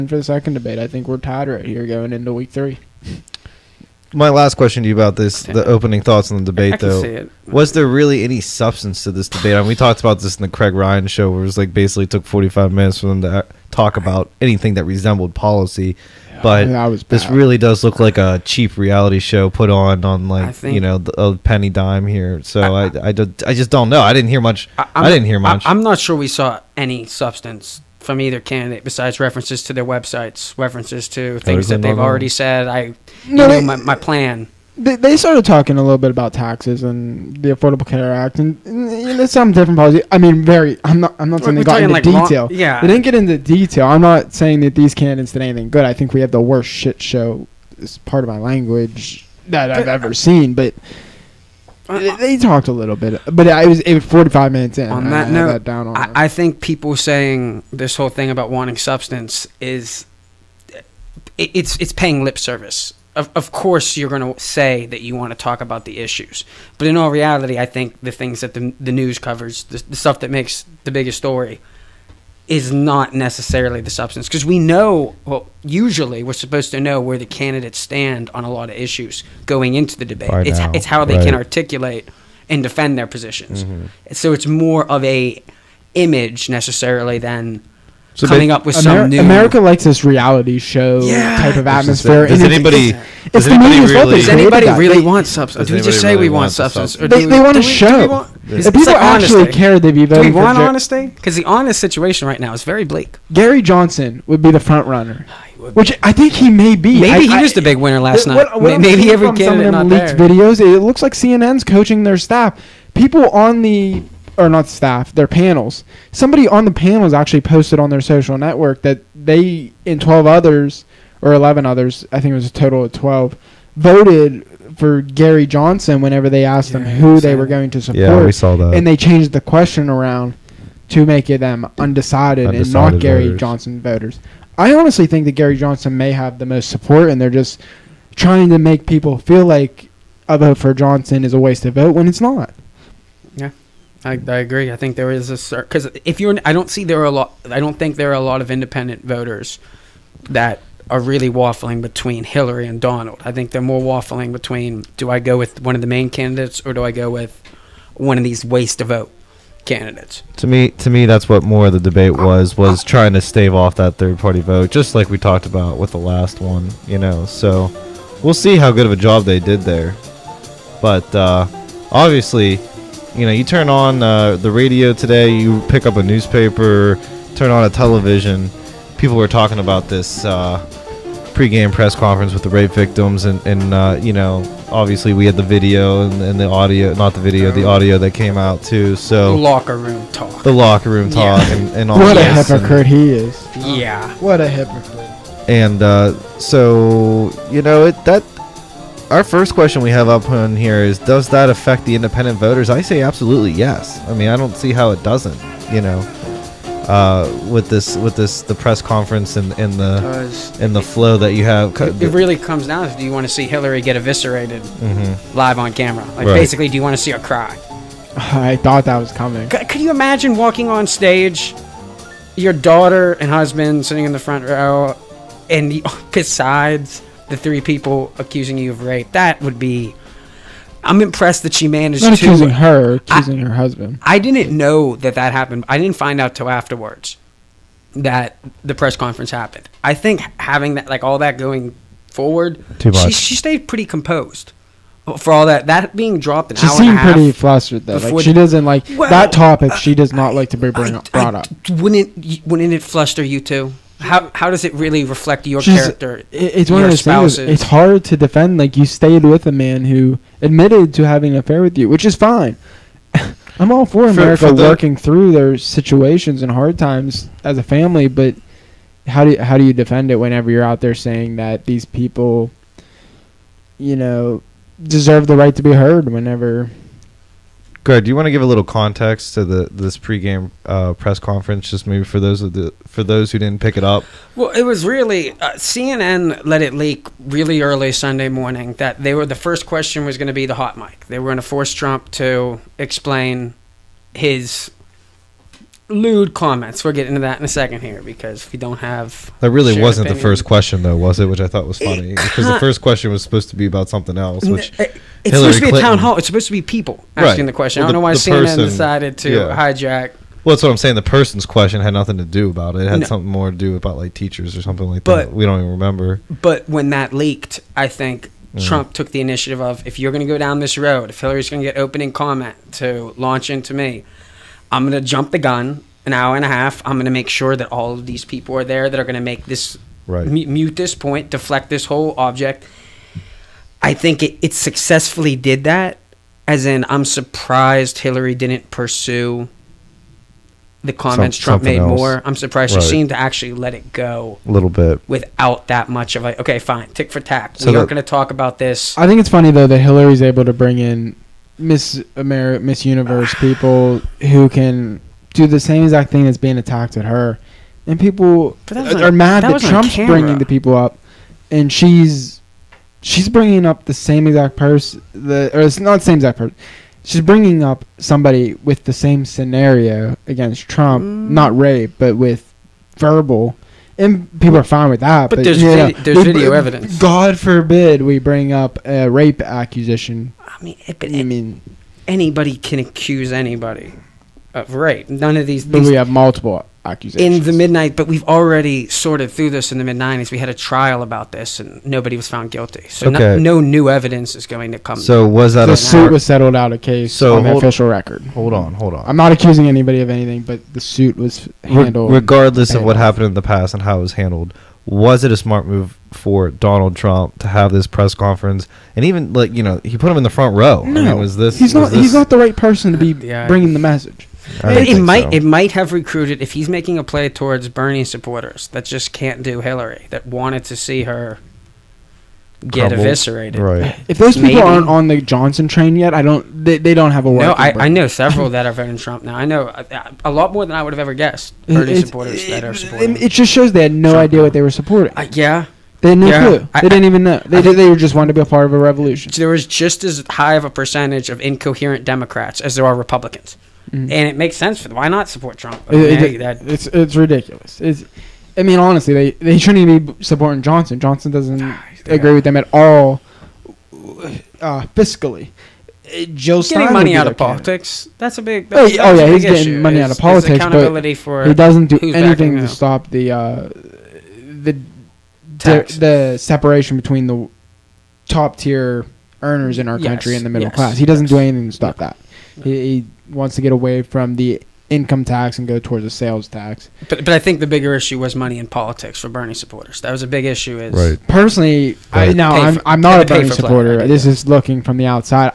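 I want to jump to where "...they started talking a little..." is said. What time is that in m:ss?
0:34.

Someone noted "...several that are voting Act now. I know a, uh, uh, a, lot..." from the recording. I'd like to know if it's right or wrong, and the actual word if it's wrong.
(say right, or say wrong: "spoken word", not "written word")
wrong: "Trump", not "Act".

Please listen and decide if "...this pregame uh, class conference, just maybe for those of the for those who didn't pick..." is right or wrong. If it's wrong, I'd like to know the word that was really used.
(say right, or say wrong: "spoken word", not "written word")
wrong: "press", not "class".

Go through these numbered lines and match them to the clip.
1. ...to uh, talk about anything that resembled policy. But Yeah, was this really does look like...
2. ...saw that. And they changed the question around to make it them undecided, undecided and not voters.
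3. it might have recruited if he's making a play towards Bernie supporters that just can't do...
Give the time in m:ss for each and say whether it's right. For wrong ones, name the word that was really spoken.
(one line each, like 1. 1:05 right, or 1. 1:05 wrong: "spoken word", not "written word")
1. 0:13 right
2. 2:08 right
3. 6:55 right.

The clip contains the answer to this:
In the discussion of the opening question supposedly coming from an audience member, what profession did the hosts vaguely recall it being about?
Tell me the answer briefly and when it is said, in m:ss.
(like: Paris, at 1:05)
teachers, at 5:14.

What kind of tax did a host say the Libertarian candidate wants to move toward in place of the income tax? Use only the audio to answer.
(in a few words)
sales tax.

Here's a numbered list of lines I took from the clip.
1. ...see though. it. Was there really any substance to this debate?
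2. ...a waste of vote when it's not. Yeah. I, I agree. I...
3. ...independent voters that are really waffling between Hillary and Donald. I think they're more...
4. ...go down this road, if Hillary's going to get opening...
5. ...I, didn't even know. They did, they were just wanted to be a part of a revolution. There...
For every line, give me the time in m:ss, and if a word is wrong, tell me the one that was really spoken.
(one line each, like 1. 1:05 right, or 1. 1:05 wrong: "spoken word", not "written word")
1. 0:06 right
2. 2:21 right
3. 2:28 right
4. 5:20 right
5. 7:16 right.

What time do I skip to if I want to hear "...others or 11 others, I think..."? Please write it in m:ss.
2:00.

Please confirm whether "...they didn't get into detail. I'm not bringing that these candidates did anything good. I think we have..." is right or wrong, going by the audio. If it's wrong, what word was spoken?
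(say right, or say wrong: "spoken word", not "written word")
wrong: "saying", not "bringing".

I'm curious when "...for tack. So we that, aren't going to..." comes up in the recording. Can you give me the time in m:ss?
5:47.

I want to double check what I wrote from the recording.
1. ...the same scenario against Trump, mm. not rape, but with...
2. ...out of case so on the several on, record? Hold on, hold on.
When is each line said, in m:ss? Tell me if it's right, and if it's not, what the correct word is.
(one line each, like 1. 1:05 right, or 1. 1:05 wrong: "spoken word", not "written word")
1. 6:08 right
2. 6:36 wrong: "official", not "several".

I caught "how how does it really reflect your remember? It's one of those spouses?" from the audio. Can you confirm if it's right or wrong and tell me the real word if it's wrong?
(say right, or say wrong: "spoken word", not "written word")
wrong: "character", not "remember".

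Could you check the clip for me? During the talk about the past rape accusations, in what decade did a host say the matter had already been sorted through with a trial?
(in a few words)
mid 90s.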